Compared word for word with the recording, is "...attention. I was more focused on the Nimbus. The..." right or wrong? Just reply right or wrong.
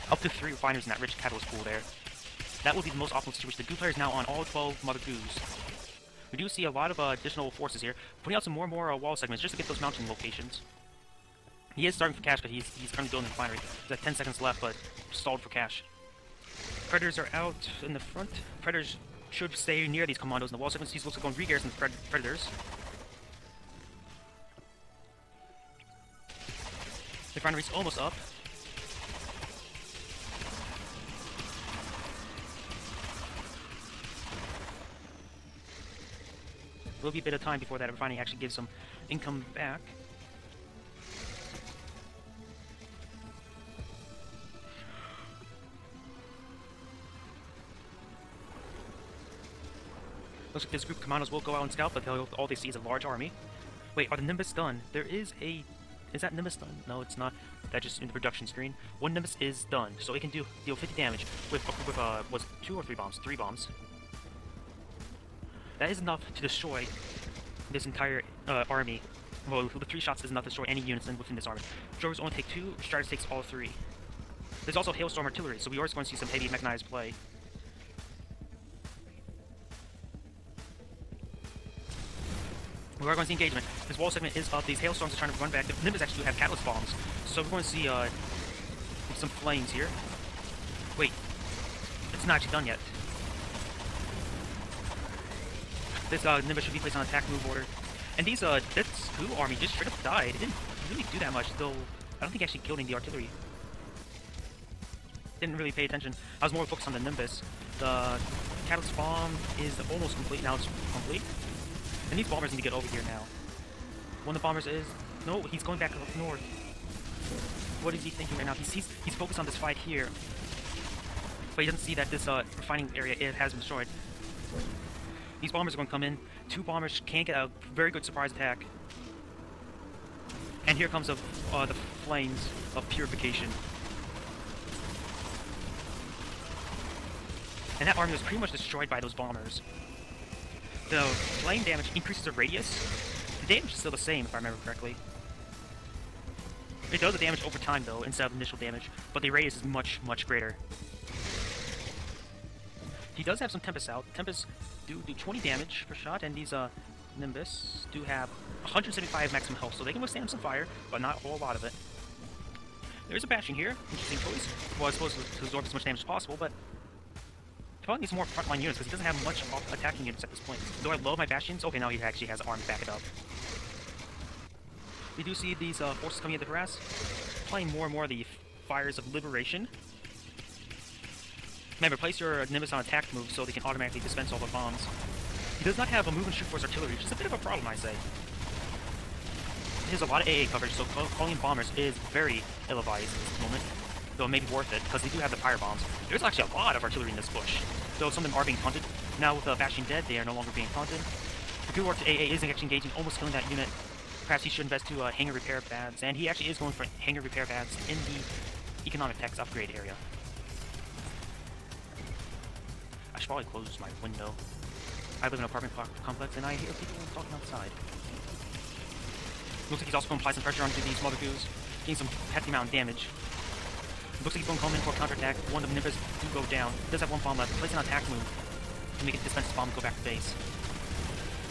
right.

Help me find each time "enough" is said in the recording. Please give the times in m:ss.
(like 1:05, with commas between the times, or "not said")
1:05, 1:10.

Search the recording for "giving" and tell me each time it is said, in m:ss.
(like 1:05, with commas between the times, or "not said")
not said.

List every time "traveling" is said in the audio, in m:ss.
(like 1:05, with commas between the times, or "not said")
not said.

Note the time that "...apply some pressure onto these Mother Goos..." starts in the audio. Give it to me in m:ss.
3:40.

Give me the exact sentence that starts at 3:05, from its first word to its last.
He does not have a move and shoot force artillery, which is a bit of a problem, I say.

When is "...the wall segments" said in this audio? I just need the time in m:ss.
0:20.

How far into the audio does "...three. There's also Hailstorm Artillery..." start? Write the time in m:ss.
1:13.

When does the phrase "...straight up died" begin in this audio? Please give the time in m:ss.
1:39.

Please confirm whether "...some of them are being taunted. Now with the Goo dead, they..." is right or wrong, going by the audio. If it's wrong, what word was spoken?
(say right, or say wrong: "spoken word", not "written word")
wrong: "Bastion", not "Goo".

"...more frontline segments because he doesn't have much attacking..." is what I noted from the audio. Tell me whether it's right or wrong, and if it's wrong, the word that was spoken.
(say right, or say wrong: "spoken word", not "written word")
wrong: "units", not "segments".